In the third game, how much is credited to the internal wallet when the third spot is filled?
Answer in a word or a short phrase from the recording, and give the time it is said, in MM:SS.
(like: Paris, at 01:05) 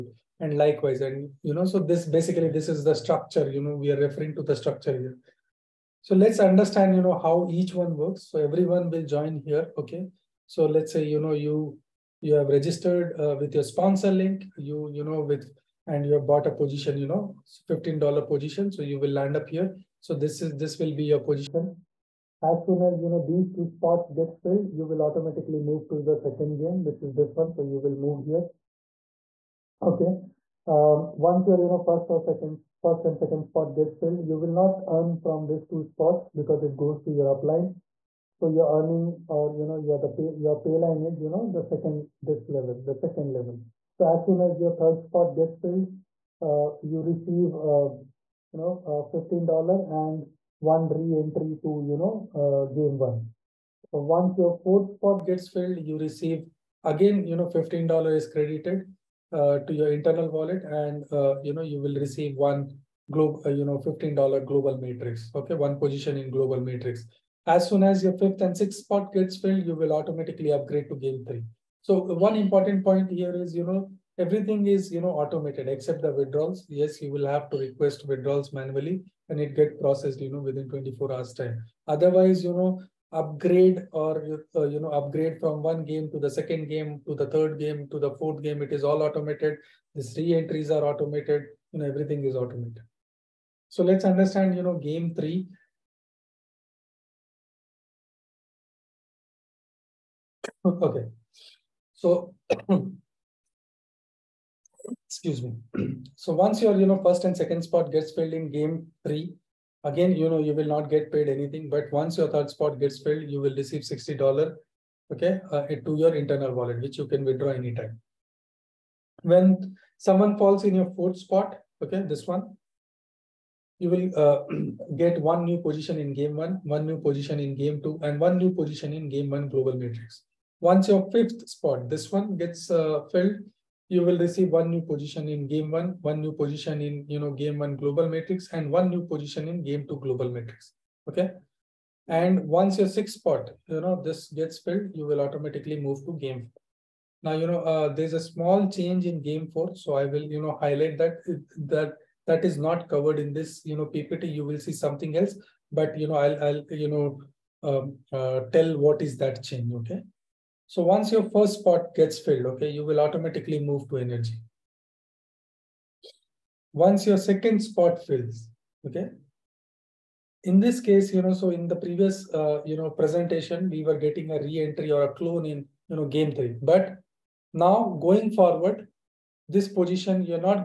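$60, at 01:53.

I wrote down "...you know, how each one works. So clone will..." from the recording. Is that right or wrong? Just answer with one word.
wrong.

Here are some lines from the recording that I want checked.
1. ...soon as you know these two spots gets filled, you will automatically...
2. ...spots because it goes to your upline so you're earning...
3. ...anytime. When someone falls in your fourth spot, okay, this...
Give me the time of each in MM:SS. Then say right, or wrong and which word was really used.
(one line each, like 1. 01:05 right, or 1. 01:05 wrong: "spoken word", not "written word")
1. 00:22 right
2. 00:35 right
3. 01:57 right.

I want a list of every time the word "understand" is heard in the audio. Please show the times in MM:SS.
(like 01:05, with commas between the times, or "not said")
00:06, 01:34.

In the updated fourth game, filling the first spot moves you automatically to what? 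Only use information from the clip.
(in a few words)
energy.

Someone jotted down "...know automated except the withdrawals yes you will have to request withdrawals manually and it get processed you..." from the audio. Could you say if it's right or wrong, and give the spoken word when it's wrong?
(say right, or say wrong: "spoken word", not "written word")
right.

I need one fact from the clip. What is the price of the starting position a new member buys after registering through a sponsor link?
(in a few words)
$15.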